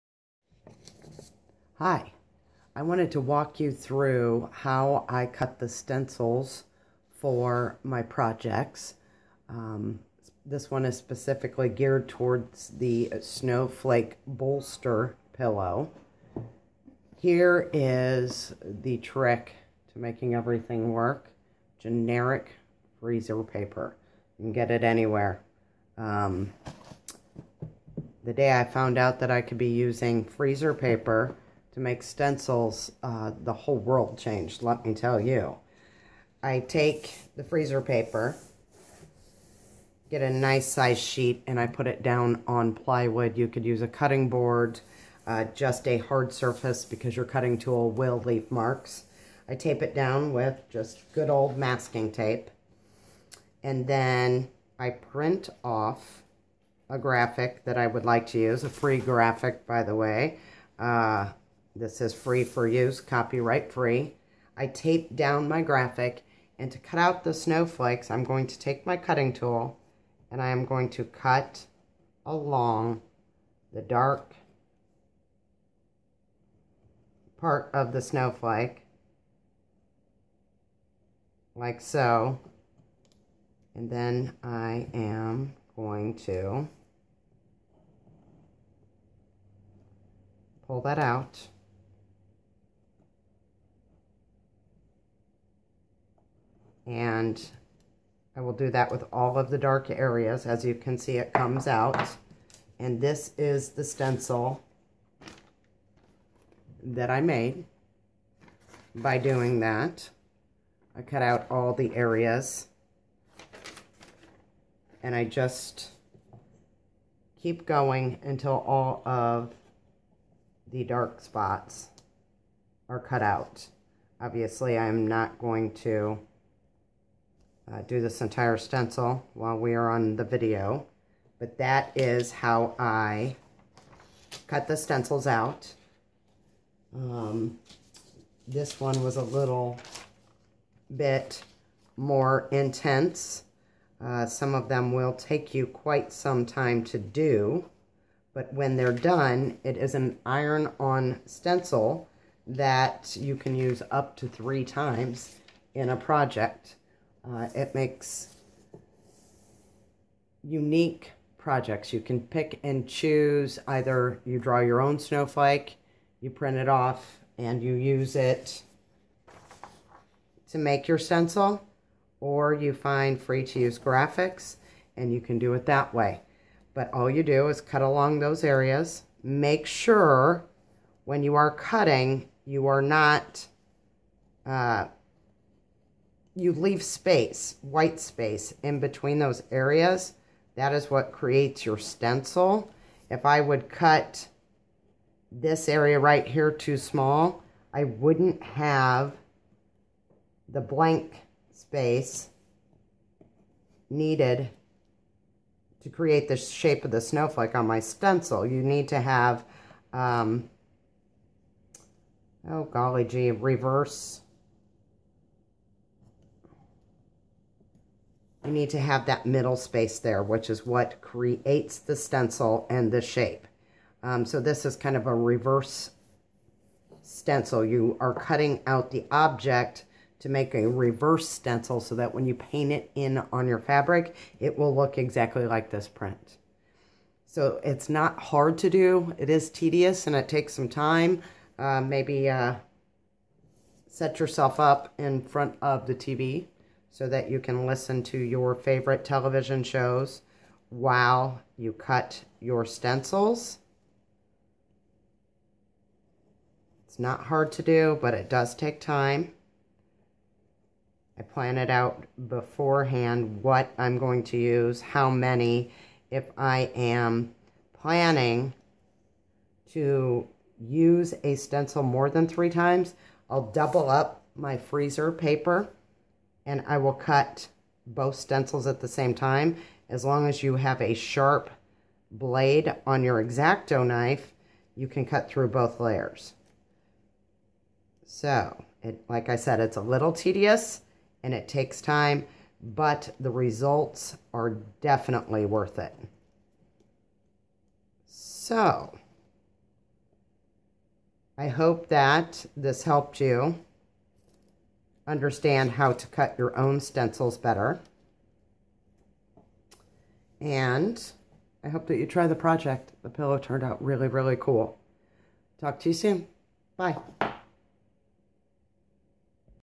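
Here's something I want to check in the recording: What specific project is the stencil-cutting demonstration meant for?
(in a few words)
Snowflake bolster pillow.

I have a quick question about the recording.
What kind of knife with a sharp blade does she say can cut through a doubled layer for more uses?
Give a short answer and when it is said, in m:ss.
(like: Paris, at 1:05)
Exacto knife, at 4:43.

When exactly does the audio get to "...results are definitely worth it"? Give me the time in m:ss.
4:53.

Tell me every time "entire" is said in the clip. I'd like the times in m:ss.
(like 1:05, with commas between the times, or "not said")
2:08.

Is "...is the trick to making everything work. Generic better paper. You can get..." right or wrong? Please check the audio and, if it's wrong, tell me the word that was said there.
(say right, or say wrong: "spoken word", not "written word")
wrong: "freezer", not "better".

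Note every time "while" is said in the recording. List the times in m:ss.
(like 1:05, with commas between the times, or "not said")
2:09, 4:10.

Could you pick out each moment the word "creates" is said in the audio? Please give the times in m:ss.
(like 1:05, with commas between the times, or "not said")
3:11, 3:25, 3:41.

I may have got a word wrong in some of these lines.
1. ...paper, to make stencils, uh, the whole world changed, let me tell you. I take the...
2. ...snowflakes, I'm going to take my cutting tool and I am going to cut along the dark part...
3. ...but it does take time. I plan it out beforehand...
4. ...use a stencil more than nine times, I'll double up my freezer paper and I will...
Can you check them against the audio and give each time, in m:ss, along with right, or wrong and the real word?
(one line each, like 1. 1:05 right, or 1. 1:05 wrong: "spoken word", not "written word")
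1. 0:30 right
2. 1:07 right
3. 4:18 right
4. 4:30 wrong: "three", not "nine".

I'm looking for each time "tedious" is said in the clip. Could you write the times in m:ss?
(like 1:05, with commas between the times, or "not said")
3:59, 4:50.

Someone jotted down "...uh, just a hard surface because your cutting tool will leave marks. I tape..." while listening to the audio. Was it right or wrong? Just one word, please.
right.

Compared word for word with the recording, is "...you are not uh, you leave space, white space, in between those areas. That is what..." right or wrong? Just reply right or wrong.
right.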